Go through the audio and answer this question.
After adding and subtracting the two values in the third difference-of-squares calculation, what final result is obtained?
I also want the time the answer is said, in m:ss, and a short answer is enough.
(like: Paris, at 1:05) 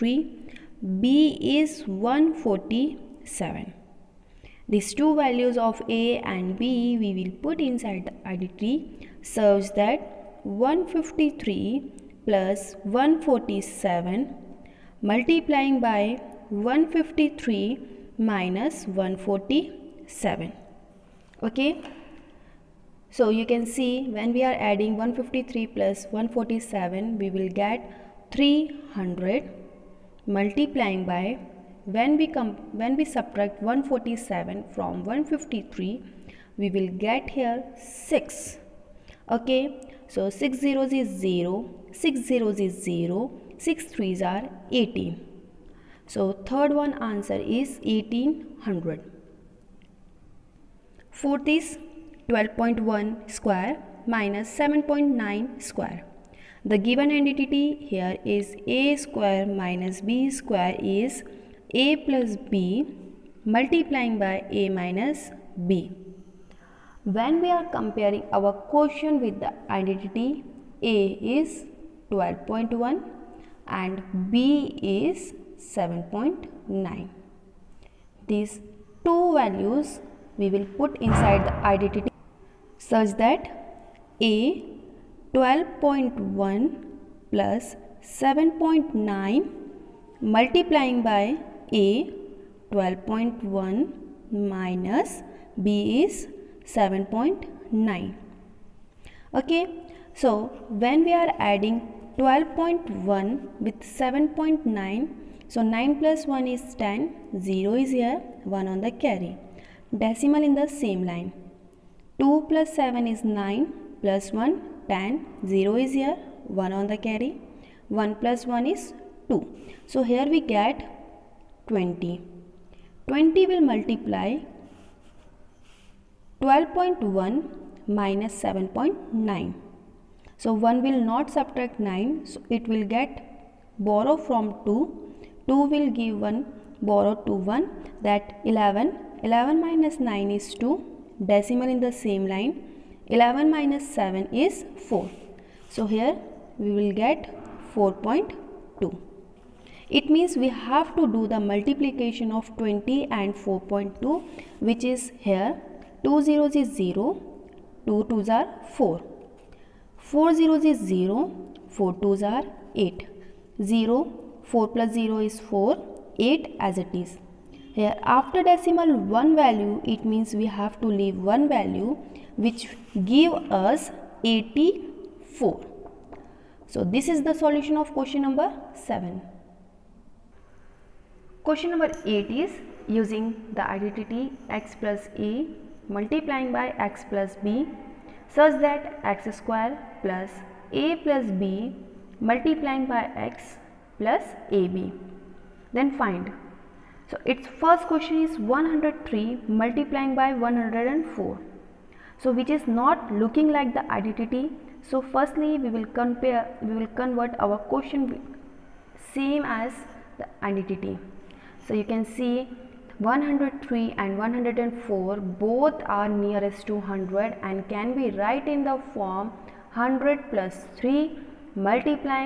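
1800, at 0:47.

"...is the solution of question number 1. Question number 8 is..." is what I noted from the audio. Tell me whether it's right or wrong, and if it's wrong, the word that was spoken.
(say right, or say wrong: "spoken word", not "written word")
wrong: "7", not "1".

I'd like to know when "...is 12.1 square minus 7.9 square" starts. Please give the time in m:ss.
0:51.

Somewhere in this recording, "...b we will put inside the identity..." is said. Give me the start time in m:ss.
0:06.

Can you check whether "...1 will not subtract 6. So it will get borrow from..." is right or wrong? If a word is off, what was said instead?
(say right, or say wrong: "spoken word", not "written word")
wrong: "9", not "6".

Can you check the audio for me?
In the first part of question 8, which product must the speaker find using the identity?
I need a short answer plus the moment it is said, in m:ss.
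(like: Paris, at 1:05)
103 × 104, at 3:18.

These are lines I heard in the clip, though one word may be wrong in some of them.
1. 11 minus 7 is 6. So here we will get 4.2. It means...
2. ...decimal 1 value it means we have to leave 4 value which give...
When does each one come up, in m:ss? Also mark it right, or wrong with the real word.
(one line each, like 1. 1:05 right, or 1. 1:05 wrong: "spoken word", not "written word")
1. 2:23 wrong: "4", not "6"
2. 2:48 wrong: "1", not "4".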